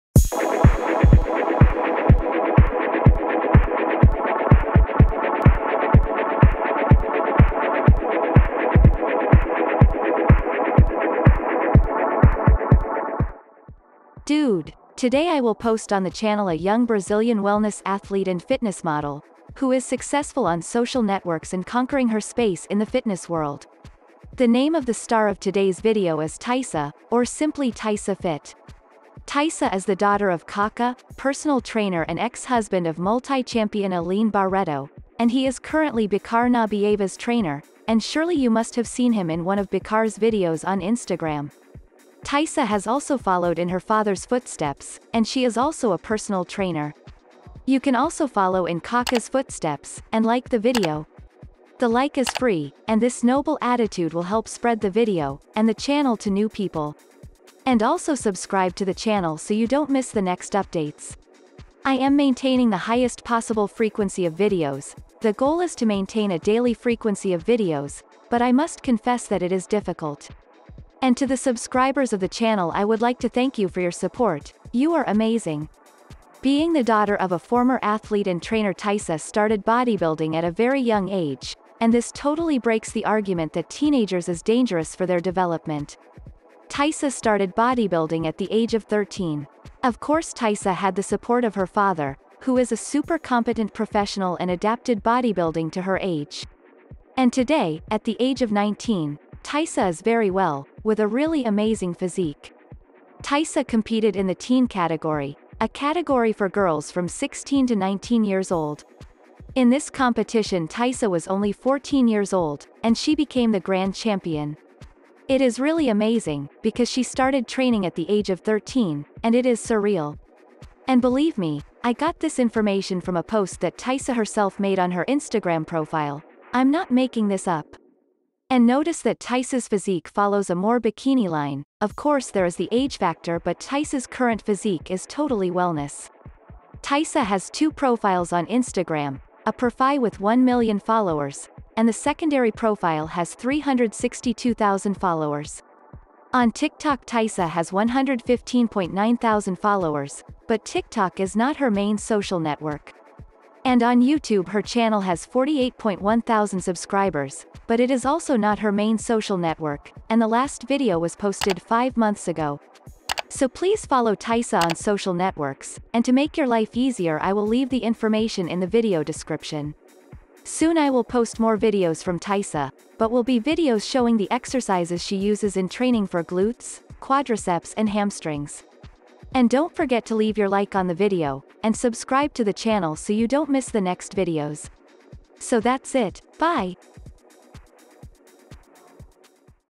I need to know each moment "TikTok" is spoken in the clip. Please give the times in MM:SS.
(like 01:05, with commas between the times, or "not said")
02:26, 02:30.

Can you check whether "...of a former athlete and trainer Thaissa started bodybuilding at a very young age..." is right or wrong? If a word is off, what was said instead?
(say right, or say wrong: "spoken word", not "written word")
right.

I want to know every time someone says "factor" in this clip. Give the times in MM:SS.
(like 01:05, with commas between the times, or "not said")
02:12.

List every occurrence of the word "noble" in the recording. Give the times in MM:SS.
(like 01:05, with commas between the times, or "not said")
00:53.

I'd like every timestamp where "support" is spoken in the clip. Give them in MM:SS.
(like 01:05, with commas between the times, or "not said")
01:13, 01:31.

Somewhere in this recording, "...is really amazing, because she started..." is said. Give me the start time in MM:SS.
01:55.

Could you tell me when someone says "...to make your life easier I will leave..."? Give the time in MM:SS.
02:46.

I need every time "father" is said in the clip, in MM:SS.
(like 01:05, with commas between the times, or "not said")
00:43, 01:31.